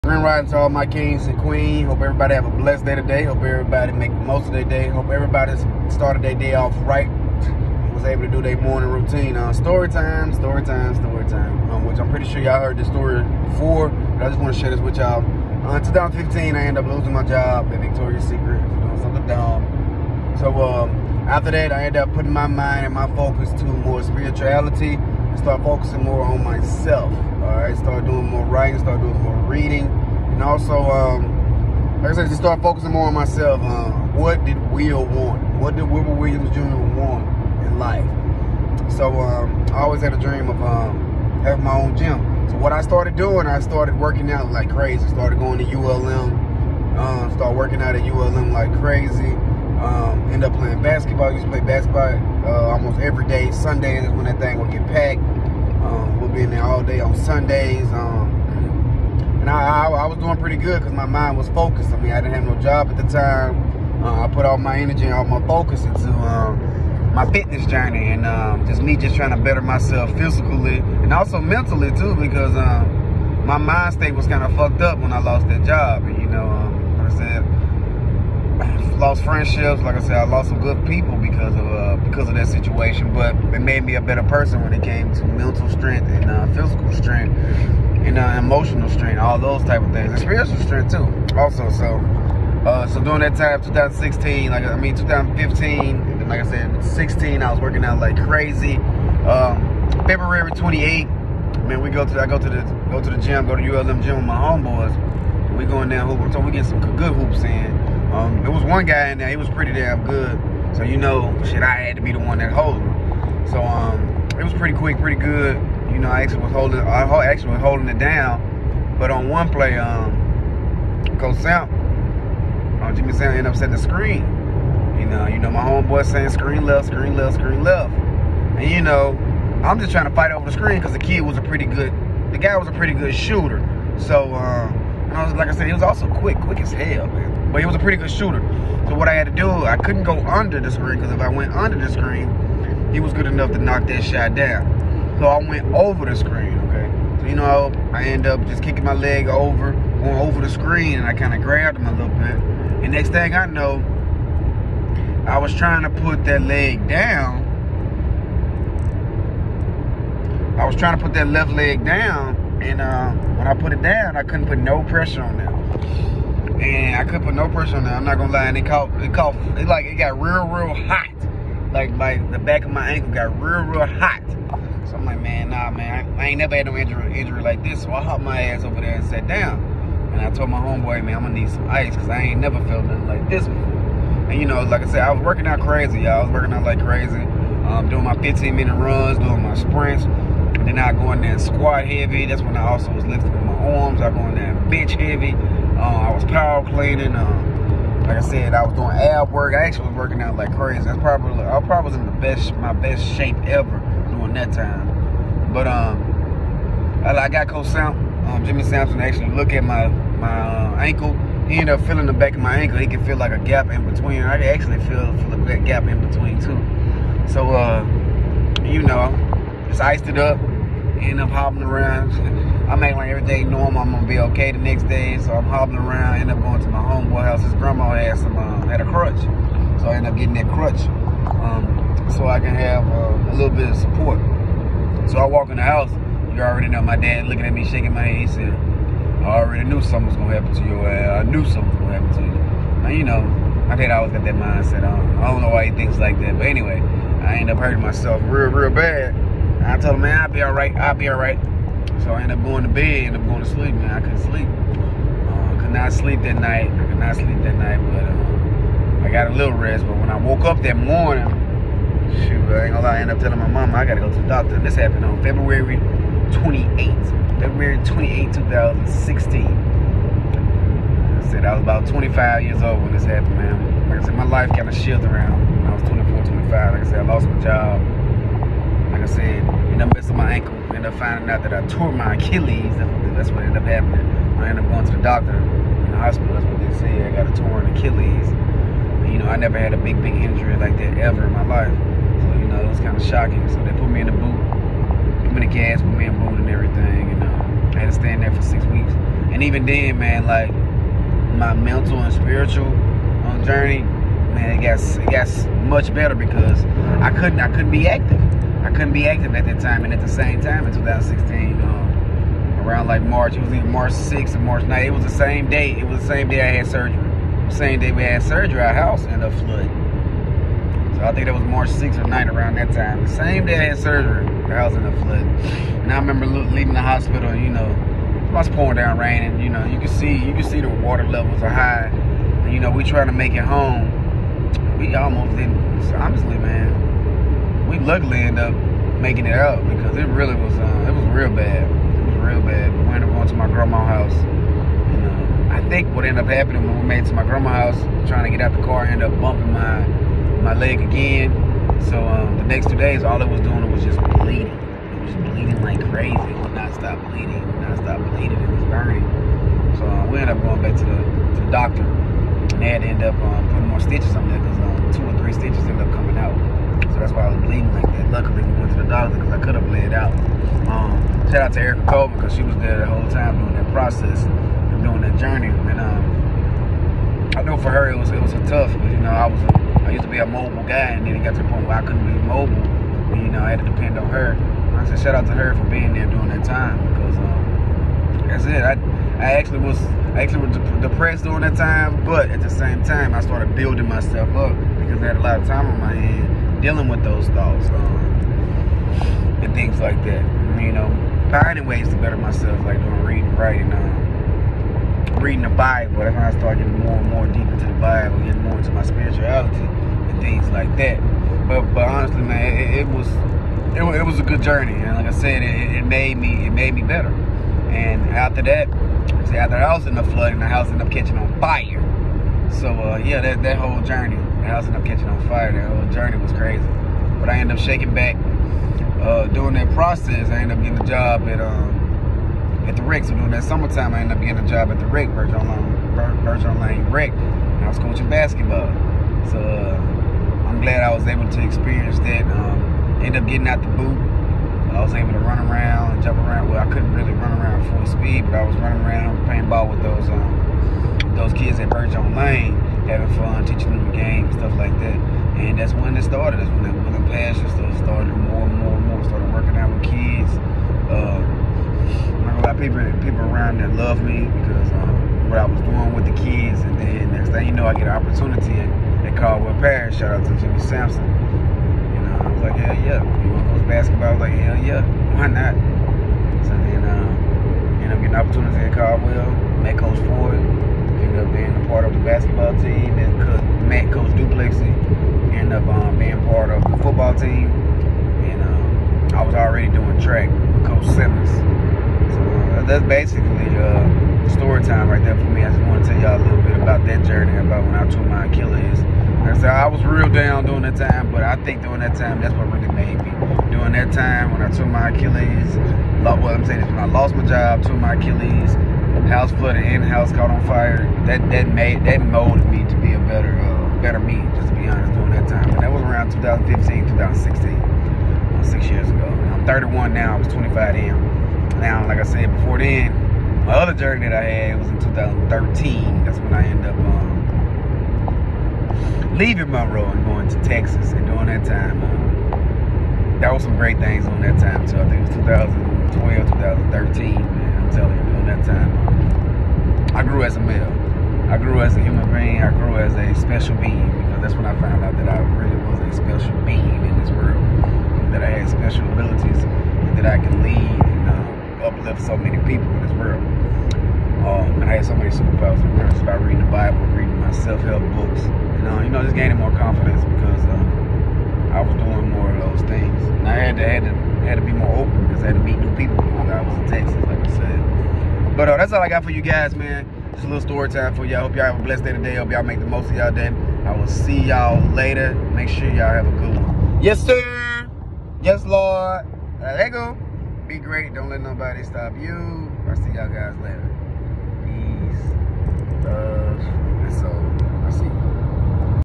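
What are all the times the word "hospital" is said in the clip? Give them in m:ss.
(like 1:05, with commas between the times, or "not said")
4:45, 5:26.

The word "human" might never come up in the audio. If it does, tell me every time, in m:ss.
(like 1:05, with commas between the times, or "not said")
9:01.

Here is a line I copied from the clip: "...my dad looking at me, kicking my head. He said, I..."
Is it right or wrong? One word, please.
wrong.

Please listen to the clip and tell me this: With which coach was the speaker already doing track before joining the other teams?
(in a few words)
Coach Simmons.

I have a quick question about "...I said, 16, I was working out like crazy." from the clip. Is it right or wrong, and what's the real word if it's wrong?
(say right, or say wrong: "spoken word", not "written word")
right.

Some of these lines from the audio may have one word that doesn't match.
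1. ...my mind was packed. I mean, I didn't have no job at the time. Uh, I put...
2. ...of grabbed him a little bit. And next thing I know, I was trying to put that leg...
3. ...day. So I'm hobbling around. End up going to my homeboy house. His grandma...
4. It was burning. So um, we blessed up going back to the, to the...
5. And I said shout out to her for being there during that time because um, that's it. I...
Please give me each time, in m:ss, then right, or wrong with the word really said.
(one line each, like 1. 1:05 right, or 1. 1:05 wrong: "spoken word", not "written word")
1. 1:00 wrong: "focused", not "packed"
2. 2:31 right
3. 3:44 right
4. 5:58 wrong: "ended", not "blessed"
5. 6:24 right.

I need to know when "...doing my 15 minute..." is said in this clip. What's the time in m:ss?
3:07.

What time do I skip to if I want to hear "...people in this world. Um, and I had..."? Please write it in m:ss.
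9:12.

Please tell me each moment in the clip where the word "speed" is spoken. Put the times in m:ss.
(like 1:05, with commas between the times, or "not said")
7:27.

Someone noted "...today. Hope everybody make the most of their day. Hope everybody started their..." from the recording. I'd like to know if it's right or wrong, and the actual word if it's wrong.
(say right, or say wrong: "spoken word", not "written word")
right.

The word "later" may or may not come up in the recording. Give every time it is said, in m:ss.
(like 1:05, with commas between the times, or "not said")
9:34, 9:43.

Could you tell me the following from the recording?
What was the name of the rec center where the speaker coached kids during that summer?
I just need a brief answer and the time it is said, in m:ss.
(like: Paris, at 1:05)
Bergeron Lane Rec, at 7:16.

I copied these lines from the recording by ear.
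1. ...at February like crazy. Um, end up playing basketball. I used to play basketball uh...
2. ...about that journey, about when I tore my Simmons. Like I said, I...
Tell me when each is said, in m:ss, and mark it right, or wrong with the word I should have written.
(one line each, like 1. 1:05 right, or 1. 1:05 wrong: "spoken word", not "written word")
1. 0:47 wrong: "ULM", not "February"
2. 8:16 wrong: "Achilles", not "Simmons".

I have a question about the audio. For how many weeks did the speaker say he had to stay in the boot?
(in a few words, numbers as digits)
6.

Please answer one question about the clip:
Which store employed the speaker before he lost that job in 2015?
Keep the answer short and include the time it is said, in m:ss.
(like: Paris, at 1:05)
Victoria's Secret, at 0:17.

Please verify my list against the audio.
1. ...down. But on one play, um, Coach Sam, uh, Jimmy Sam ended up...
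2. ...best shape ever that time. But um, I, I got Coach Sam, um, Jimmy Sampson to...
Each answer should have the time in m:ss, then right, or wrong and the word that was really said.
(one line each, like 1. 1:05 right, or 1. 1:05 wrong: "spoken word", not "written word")
1. 1:57 right
2. 3:22 right.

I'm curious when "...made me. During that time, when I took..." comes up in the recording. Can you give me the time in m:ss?
8:22.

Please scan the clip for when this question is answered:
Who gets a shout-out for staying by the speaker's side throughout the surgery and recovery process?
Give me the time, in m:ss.
6:11.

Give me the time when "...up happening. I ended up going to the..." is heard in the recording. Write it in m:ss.
4:43.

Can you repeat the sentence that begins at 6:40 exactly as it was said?
You know, finding ways to better myself, like doing reading, writing.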